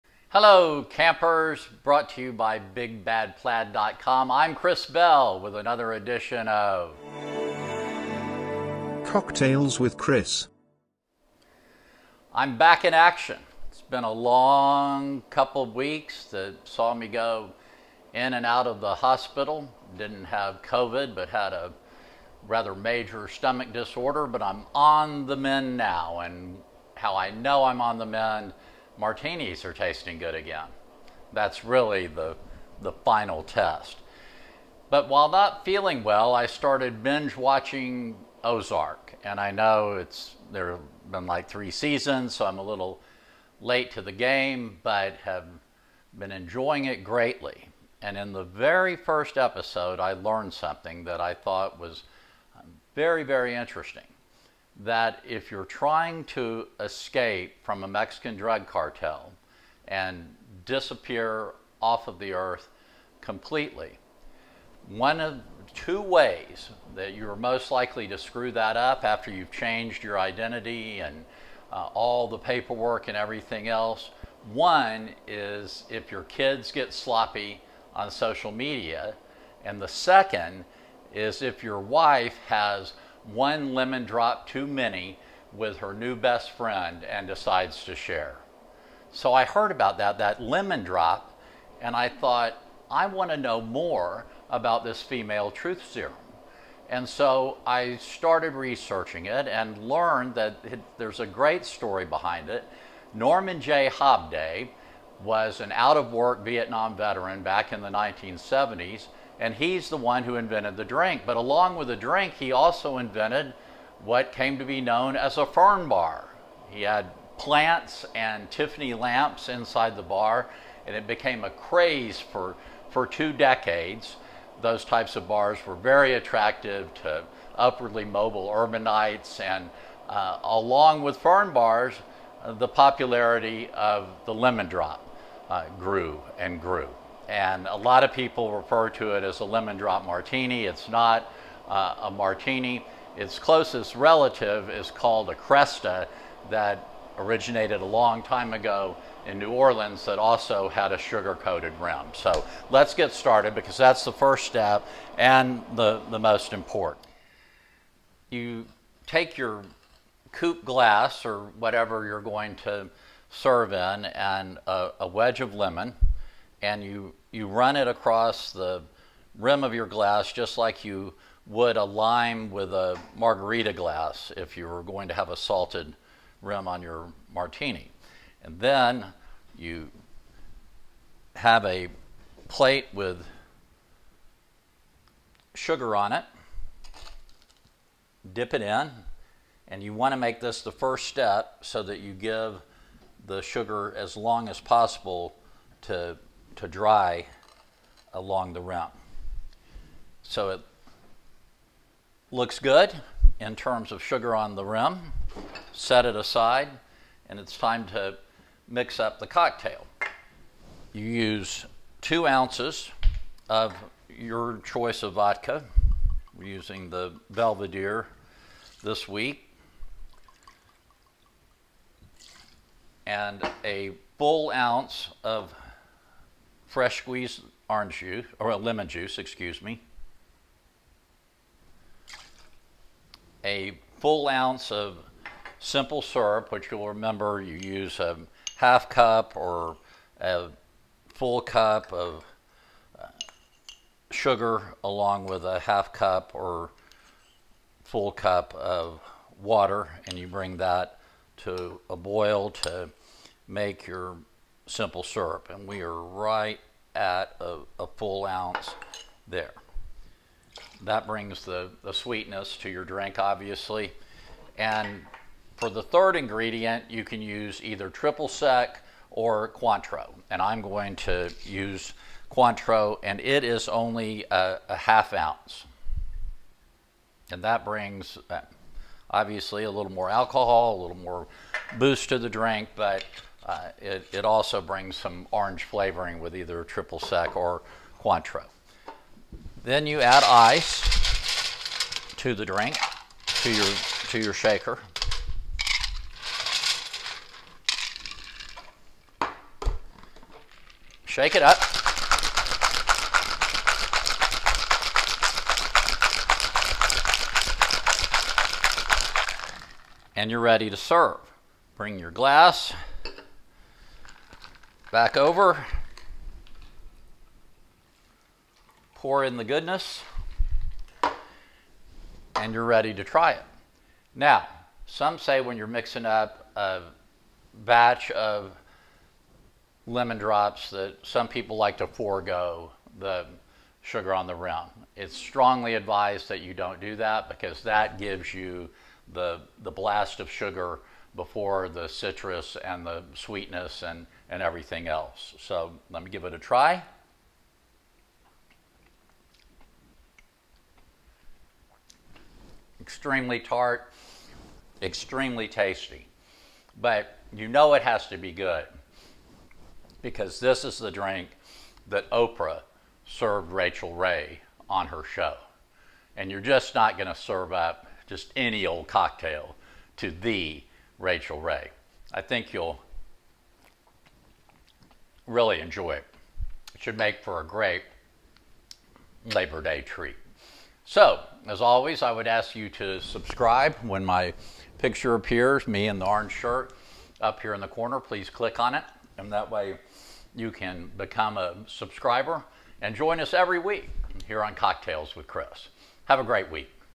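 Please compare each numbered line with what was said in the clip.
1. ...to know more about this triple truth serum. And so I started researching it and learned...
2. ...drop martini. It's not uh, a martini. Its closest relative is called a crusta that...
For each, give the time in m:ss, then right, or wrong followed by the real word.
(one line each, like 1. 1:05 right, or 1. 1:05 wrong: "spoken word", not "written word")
1. 1:33 wrong: "female", not "triple"
2. 2:19 right.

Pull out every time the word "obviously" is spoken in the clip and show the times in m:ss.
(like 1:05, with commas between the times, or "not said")
4:23, 4:39.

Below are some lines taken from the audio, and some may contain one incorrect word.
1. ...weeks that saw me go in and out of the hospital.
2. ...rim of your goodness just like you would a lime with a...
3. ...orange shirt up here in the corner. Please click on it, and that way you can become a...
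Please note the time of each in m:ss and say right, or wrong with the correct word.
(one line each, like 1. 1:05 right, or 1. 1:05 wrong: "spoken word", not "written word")
1. 0:15 right
2. 2:49 wrong: "glass", not "goodness"
3. 6:26 right.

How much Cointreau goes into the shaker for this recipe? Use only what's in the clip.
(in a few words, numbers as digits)
half ounce.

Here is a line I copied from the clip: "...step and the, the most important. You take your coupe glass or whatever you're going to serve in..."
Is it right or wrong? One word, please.
right.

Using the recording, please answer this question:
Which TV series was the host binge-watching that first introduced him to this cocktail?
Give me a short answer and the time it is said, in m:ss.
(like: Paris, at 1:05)
Ozark, at 0:38.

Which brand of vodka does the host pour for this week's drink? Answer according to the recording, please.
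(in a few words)
Belvedere.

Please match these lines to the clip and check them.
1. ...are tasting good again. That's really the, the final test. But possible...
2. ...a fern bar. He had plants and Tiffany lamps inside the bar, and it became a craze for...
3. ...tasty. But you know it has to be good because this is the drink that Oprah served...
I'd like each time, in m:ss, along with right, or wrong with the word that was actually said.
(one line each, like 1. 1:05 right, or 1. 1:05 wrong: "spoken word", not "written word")
1. 0:29 wrong: "while", not "possible"
2. 1:55 right
3. 5:55 right.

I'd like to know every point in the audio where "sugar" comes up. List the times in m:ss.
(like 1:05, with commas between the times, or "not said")
2:30, 3:05, 3:13, 3:24, 4:04, 5:33, 5:40.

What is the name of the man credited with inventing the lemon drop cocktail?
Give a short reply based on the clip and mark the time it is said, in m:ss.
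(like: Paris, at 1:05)
Norman J. Hobday, at 1:43.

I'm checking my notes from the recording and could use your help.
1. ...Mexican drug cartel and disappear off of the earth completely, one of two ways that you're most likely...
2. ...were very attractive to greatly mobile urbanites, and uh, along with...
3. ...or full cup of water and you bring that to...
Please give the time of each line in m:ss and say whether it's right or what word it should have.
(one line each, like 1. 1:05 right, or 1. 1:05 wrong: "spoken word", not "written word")
1. 0:57 right
2. 2:05 wrong: "upwardly", not "greatly"
3. 4:06 right.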